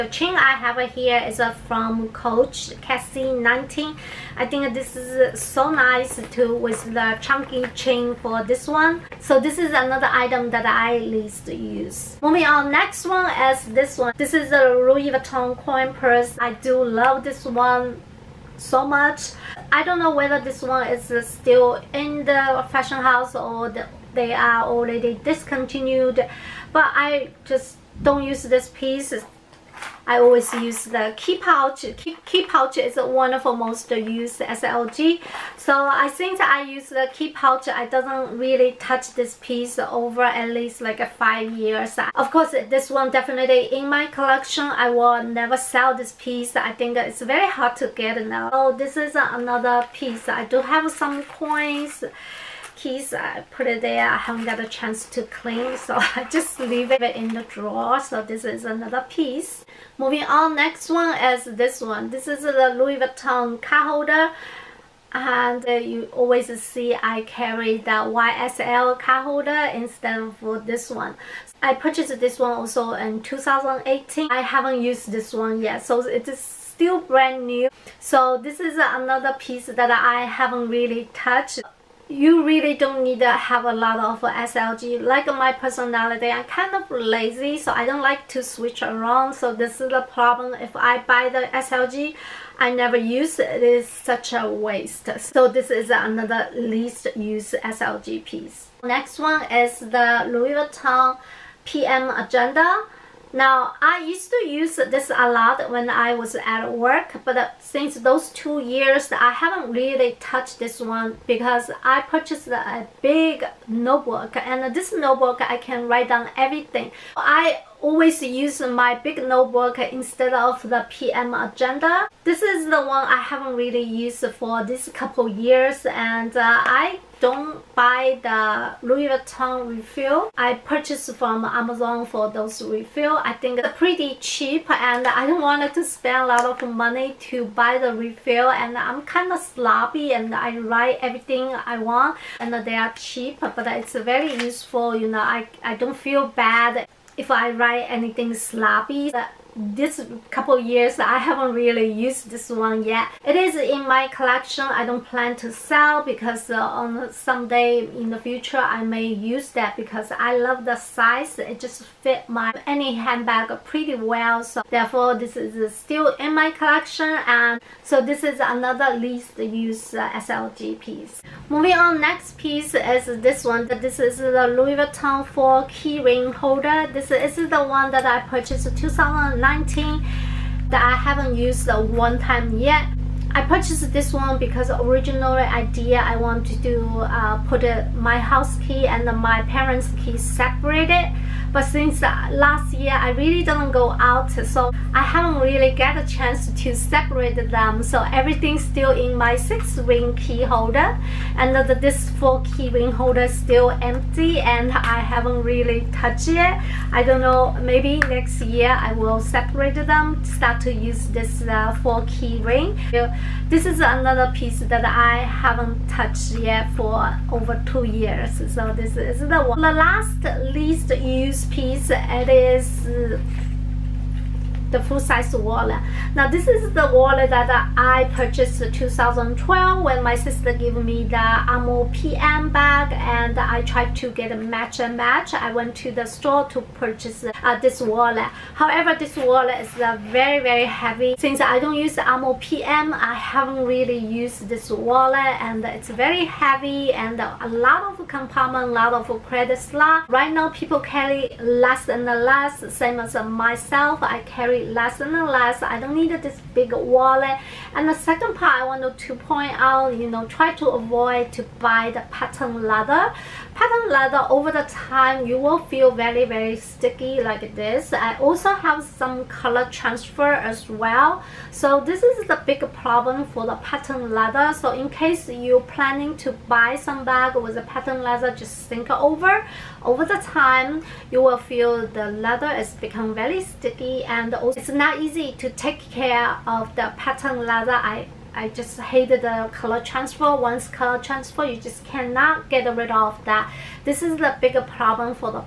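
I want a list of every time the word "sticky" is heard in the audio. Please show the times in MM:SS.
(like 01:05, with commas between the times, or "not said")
04:26, 04:43.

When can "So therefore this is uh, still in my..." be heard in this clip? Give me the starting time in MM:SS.
02:44.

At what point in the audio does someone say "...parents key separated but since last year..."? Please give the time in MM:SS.
03:09.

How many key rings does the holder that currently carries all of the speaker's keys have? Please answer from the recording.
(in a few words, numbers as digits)
6.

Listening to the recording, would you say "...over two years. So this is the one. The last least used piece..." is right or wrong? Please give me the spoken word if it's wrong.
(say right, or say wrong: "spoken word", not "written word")
right.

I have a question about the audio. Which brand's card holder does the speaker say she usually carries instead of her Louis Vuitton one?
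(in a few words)
YSL.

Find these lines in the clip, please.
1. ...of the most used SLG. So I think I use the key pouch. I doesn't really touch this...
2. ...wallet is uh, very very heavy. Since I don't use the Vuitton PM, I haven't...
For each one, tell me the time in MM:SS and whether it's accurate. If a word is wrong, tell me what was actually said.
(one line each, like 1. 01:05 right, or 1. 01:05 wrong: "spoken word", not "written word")
1. 00:33 right
2. 03:59 wrong: "Alma", not "Vuitton".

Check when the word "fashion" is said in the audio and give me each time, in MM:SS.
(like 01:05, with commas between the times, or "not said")
00:22.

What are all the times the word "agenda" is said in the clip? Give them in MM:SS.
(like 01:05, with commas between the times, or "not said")
01:42, 02:01.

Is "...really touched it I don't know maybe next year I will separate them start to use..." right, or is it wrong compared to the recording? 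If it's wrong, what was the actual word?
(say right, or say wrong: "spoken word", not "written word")
right.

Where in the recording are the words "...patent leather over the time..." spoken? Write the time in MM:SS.
04:23.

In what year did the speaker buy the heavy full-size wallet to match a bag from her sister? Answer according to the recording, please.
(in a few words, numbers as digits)
2012.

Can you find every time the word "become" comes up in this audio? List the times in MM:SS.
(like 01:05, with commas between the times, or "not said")
04:42.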